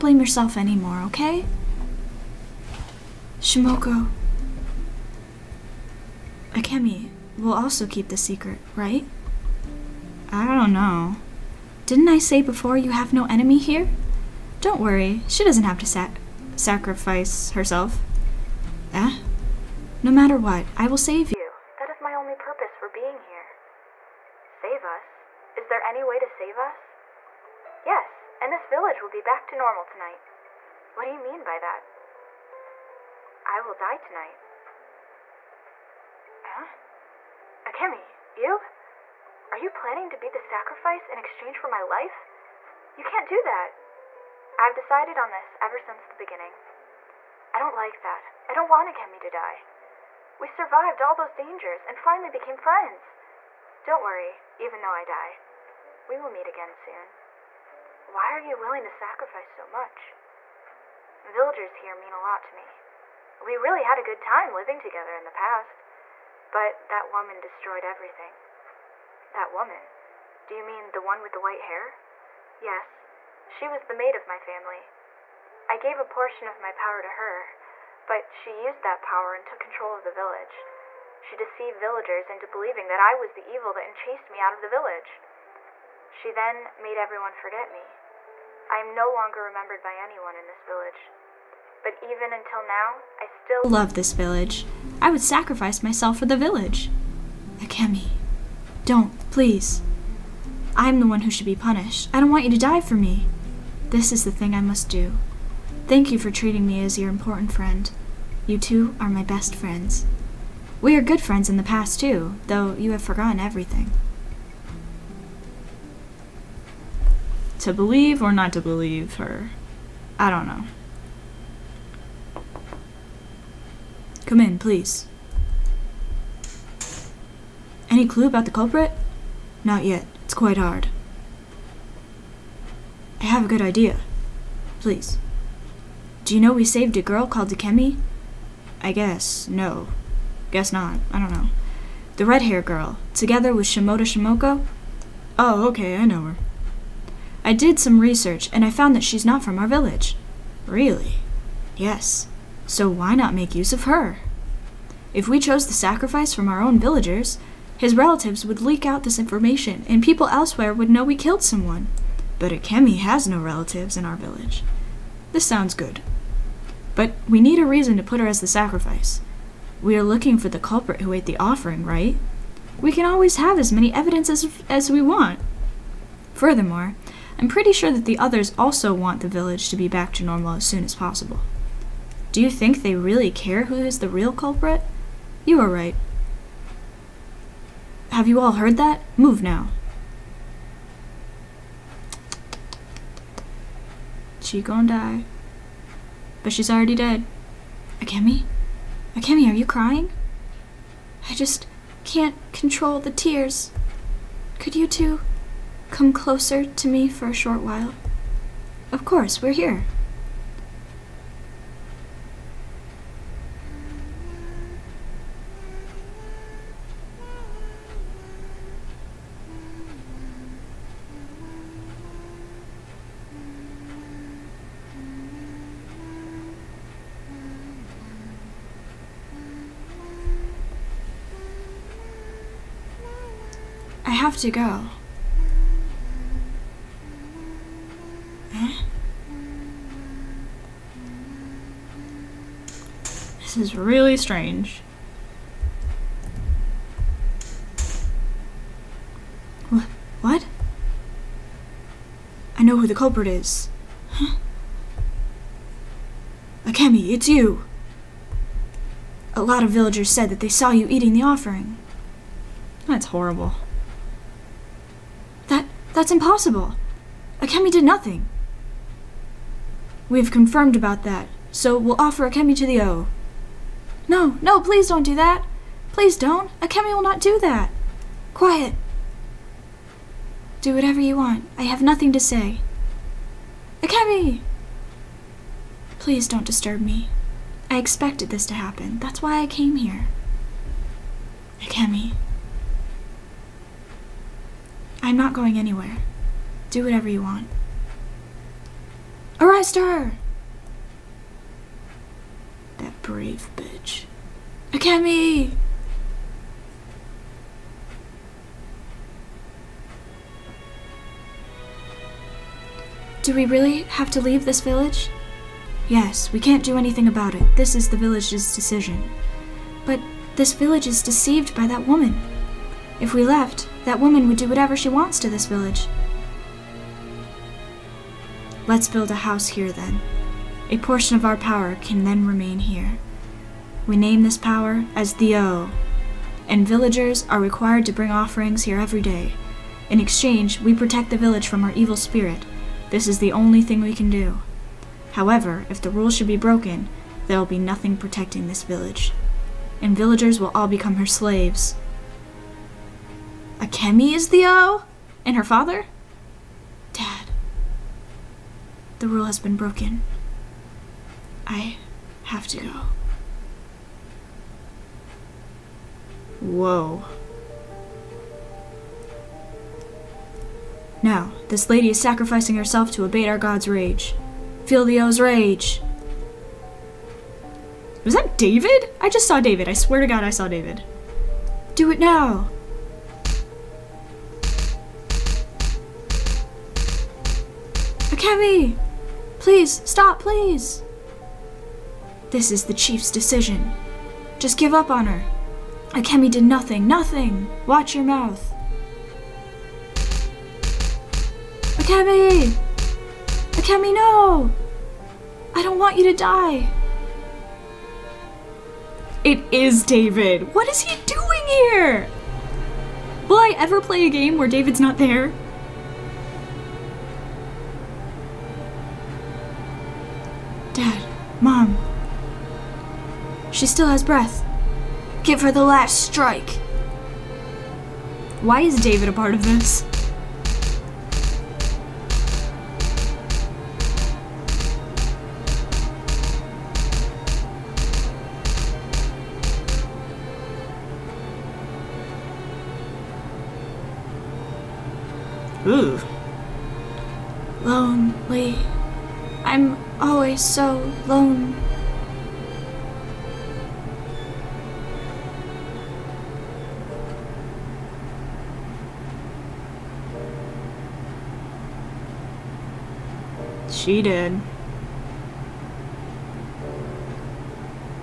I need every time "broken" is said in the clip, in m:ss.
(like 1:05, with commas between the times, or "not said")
5:46, 5:59.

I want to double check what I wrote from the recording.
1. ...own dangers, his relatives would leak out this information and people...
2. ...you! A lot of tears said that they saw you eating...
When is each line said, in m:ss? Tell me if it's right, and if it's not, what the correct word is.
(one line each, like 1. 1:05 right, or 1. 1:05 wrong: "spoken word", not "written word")
1. 2:36 wrong: "villagers", not "dangers"
2. 4:17 wrong: "villagers", not "tears".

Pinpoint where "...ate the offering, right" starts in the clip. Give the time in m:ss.
2:51.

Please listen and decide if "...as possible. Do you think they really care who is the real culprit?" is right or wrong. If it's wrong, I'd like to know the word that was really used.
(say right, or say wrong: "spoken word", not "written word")
right.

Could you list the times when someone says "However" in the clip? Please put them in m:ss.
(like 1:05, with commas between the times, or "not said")
5:45.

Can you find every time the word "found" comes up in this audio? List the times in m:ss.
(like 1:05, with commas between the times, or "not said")
2:28.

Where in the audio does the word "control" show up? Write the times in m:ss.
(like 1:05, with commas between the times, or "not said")
1:19, 3:22.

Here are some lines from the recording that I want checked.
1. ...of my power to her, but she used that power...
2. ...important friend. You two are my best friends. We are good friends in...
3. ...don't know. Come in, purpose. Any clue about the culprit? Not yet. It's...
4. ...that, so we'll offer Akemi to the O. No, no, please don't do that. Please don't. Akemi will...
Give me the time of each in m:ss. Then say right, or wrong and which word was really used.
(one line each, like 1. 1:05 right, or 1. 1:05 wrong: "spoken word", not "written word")
1. 1:16 right
2. 1:47 right
3. 2:00 wrong: "please", not "purpose"
4. 4:31 right.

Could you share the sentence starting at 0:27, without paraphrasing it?
Yes, and this village will be back to normal tonight.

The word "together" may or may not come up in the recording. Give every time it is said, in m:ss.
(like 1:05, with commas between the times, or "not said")
1:04, 2:23.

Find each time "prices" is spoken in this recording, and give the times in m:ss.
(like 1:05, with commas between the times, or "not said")
not said.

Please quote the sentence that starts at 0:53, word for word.
Don't worry, even though I die.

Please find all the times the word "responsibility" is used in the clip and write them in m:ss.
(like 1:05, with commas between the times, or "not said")
not said.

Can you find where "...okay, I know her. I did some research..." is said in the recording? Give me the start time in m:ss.
2:25.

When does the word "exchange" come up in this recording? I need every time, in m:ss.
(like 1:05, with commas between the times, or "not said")
0:41, 5:39.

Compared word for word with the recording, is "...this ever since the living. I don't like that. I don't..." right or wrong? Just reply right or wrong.
wrong.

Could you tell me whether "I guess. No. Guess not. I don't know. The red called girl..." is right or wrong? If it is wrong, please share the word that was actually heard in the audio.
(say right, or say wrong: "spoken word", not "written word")
wrong: "haired", not "called".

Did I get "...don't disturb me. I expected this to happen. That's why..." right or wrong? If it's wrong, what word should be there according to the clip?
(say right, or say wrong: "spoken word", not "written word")
right.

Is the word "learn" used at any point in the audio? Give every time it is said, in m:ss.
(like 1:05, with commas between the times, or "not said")
not said.